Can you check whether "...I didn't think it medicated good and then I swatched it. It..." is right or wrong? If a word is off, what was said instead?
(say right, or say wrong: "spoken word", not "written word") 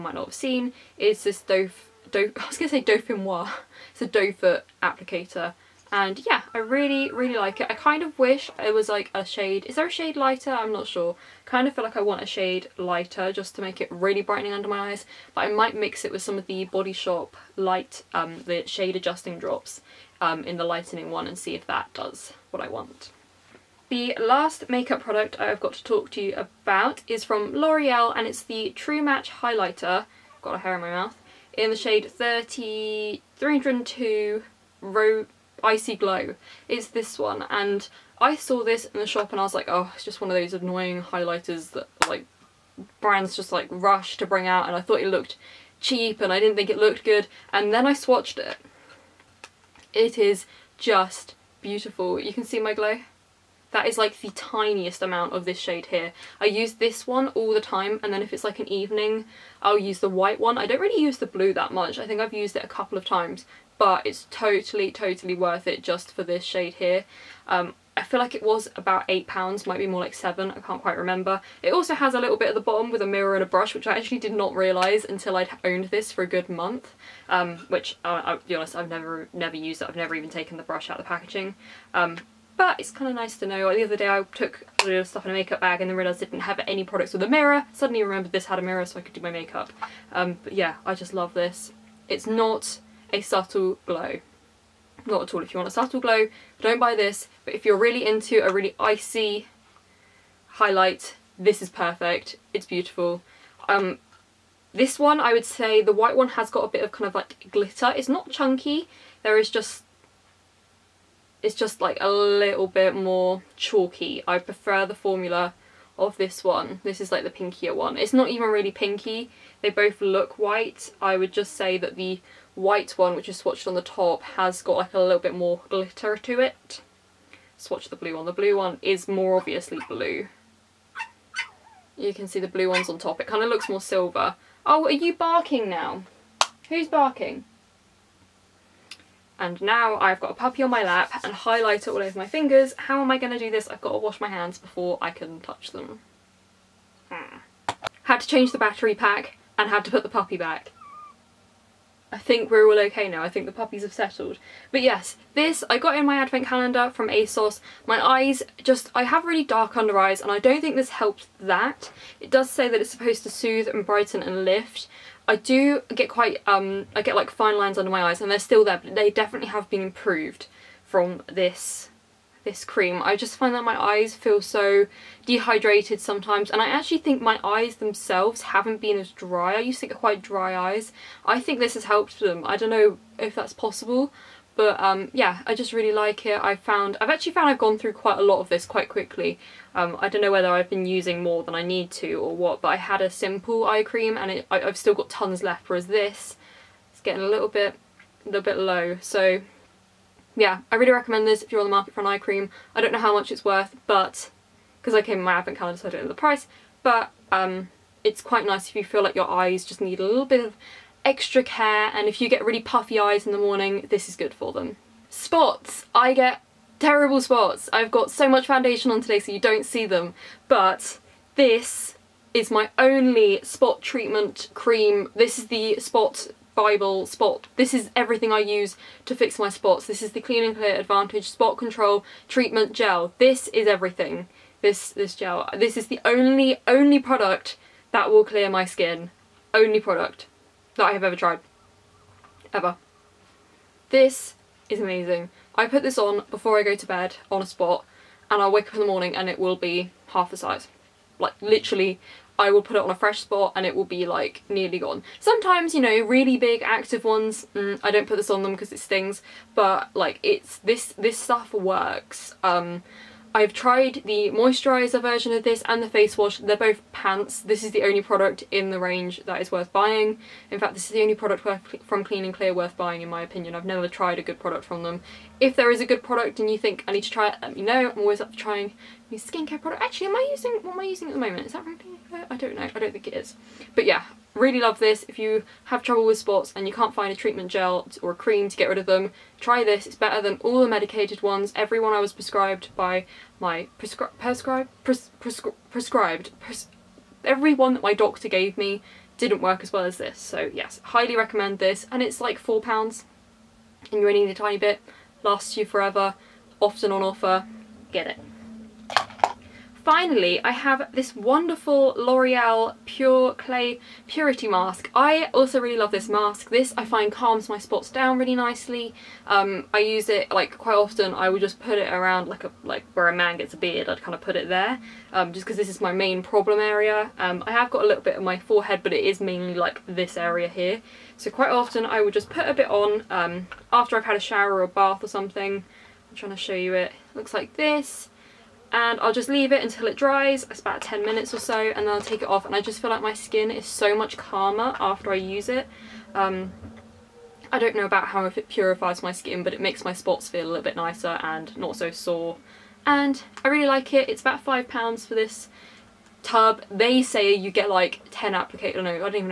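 wrong: "looked", not "medicated".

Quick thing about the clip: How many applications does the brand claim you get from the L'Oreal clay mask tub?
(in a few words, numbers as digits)
10.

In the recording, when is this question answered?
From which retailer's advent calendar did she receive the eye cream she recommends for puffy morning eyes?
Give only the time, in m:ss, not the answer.
2:37.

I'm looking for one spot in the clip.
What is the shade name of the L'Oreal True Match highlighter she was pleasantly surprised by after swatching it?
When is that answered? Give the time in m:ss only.
0:35.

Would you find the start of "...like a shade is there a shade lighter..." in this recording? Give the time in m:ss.
0:08.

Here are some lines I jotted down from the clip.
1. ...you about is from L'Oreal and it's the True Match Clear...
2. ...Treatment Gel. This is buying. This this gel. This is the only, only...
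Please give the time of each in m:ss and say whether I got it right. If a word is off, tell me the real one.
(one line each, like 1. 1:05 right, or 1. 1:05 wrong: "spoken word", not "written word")
1. 0:26 wrong: "Highlighter", not "Clear"
2. 3:52 wrong: "everything", not "buying".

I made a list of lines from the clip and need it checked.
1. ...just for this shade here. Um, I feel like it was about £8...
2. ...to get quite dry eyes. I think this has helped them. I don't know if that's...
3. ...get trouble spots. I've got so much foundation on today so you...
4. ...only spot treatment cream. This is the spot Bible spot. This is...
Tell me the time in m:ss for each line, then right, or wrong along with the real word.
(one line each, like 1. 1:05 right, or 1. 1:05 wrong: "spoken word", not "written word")
1. 1:05 right
2. 2:59 right
3. 3:36 wrong: "terrible", not "trouble"
4. 3:42 right.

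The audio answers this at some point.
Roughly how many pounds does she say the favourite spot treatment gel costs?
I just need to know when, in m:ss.
5:02.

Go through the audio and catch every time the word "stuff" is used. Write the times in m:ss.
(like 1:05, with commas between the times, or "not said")
1:25, 4:21.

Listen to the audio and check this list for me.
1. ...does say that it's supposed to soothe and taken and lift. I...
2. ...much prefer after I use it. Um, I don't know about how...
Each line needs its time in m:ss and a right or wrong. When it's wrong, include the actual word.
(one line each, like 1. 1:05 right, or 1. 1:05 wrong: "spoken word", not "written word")
1. 2:42 wrong: "brighten", not "taken"
2. 5:43 wrong: "calmer", not "prefer".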